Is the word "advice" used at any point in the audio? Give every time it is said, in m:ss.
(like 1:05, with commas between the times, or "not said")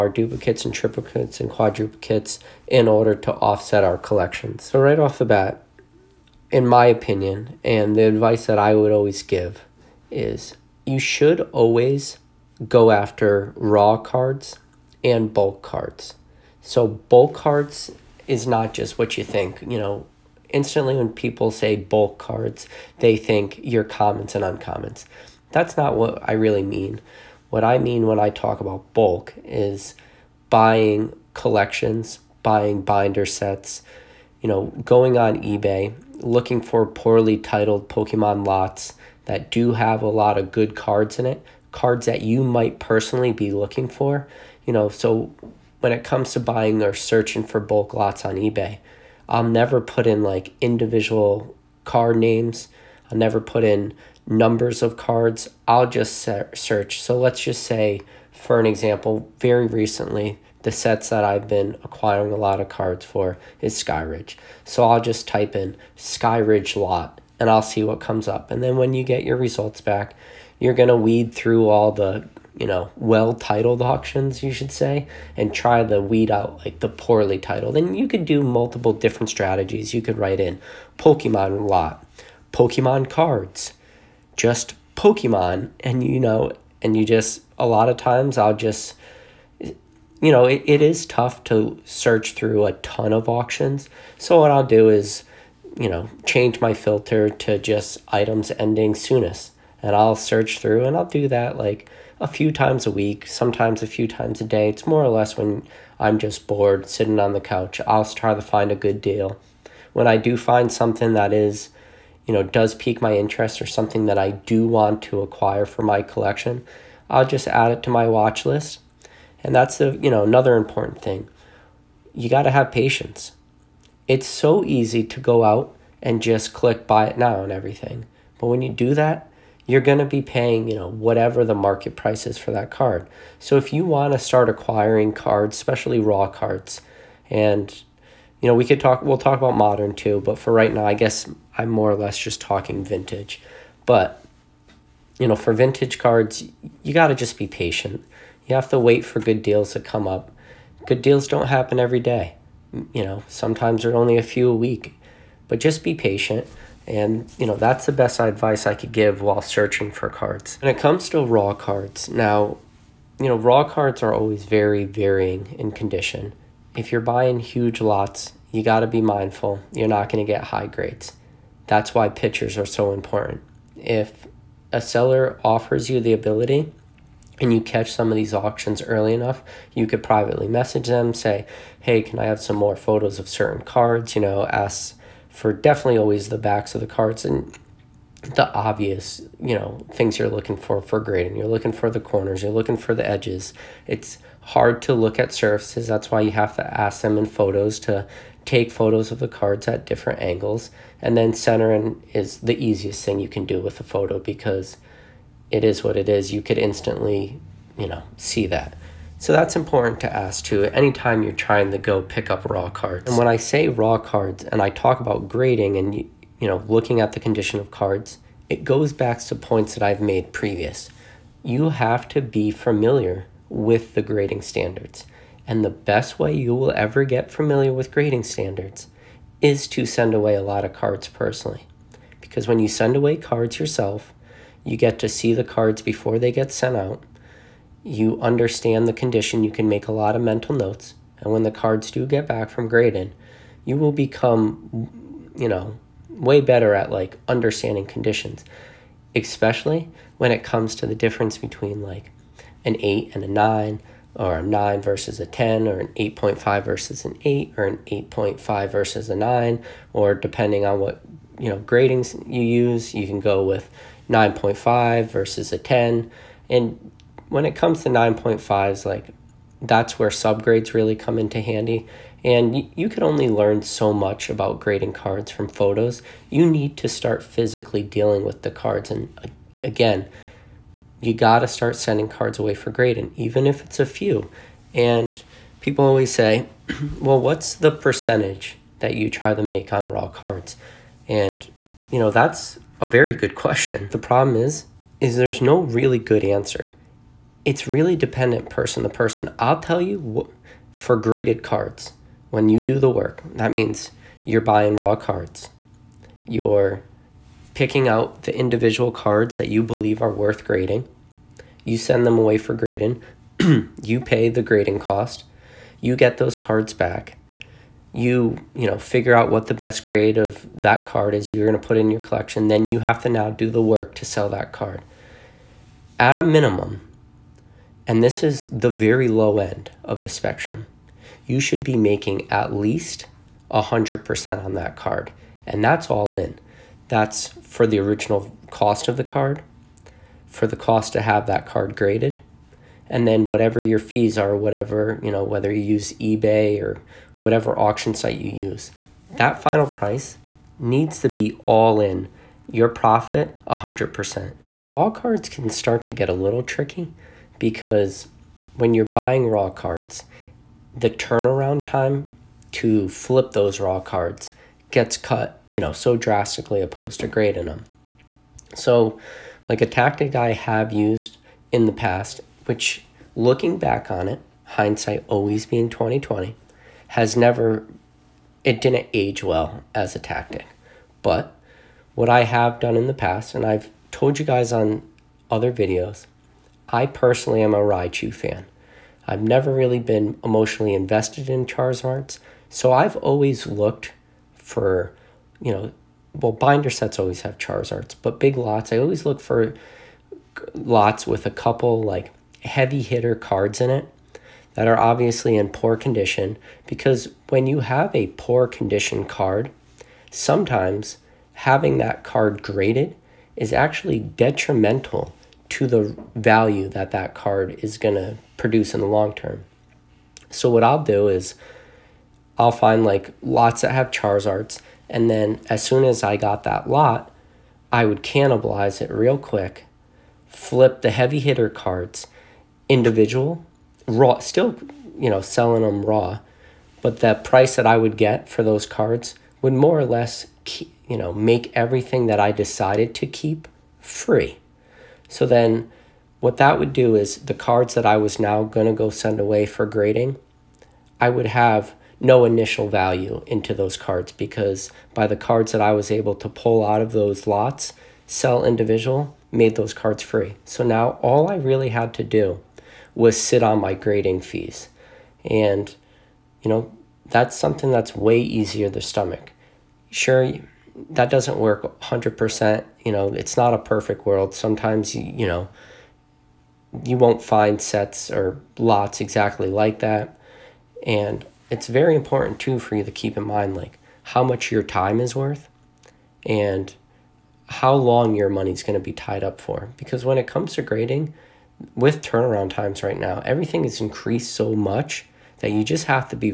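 0:08, 2:38.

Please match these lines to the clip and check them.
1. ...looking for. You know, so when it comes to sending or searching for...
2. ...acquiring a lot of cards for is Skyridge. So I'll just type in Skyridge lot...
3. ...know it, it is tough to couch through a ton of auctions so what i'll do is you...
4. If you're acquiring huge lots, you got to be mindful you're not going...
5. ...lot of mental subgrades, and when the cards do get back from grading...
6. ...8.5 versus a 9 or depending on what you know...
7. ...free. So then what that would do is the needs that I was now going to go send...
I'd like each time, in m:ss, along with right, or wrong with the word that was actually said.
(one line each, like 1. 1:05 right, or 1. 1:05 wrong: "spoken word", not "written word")
1. 0:43 wrong: "buying", not "sending"
2. 1:01 right
3. 1:30 wrong: "search", not "couch"
4. 2:46 wrong: "buying", not "acquiring"
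5. 3:59 wrong: "notes", not "subgrades"
6. 4:17 right
7. 7:23 wrong: "cards", not "needs".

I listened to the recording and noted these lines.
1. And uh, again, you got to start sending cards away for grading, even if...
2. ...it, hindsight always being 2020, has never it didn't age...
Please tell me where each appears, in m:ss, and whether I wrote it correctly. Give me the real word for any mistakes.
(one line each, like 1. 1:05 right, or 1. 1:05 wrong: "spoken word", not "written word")
1. 4:38 right
2. 6:14 right.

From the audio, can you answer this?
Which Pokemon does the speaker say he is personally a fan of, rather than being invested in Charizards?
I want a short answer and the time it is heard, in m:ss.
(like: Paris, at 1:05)
Raichu, at 6:27.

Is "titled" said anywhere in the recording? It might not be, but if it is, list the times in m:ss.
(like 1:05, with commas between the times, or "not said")
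0:37, 1:13, 1:17.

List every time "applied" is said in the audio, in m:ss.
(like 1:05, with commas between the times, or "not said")
not said.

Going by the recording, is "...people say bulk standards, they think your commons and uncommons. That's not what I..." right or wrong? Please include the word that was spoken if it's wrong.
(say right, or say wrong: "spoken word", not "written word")
wrong: "cards", not "standards".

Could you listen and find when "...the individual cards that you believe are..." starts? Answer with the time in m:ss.
5:08.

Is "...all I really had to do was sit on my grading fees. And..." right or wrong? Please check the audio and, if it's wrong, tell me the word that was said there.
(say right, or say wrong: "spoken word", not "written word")
right.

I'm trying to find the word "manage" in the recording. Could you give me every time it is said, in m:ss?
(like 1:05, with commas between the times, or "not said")
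not said.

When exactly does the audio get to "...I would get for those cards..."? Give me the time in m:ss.
7:17.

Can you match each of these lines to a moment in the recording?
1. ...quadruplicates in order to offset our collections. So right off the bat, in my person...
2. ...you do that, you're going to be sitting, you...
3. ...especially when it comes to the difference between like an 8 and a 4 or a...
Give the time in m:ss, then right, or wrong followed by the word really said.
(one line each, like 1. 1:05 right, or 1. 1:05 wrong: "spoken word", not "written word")
1. 0:01 wrong: "opinion", not "person"
2. 2:08 wrong: "paying", not "sitting"
3. 4:09 wrong: "9", not "4".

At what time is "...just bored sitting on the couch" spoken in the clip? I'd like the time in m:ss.
1:46.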